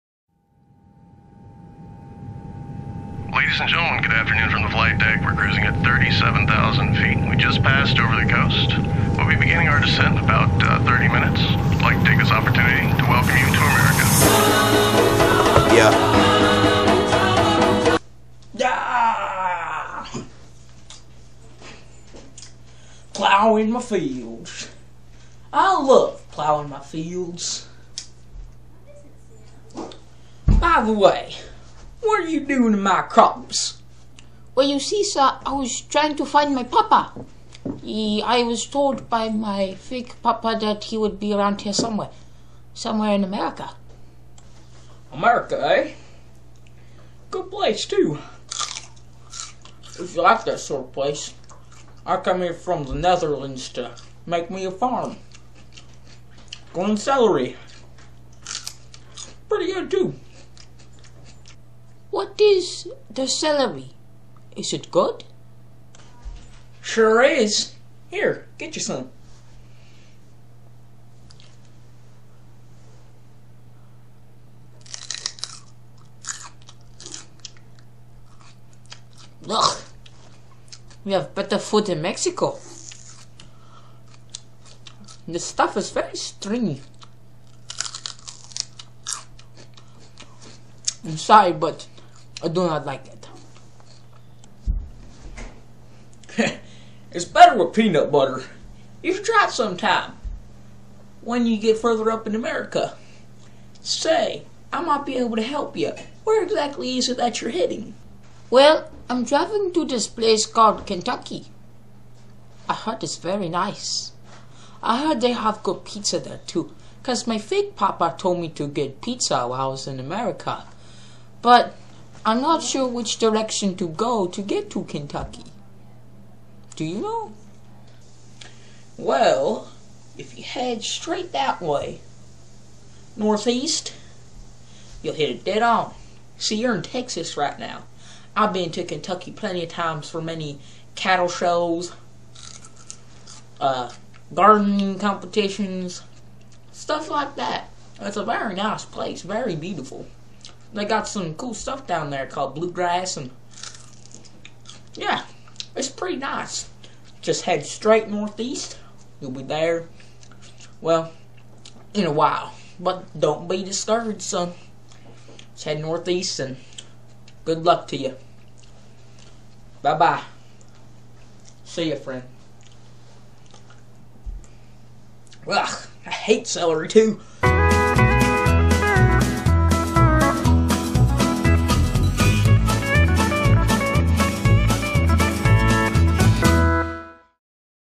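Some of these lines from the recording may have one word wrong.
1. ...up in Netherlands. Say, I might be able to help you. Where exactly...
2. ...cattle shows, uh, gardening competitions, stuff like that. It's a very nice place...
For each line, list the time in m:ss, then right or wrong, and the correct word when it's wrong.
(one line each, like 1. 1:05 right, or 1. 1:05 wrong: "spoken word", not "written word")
1. 1:42 wrong: "America", not "Netherlands"
2. 2:20 right.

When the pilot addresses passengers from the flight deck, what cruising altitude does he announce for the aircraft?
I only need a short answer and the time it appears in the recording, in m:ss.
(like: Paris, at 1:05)
37,000 feet, at 0:05.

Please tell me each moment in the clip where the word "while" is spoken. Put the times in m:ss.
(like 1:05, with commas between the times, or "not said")
1:59, 2:42.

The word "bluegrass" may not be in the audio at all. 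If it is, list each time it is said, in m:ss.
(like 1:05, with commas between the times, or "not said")
2:32.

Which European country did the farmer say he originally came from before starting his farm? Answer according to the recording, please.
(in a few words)
Netherlands.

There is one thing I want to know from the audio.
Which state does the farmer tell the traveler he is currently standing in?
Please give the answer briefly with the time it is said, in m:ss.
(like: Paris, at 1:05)
Texas, at 2:16.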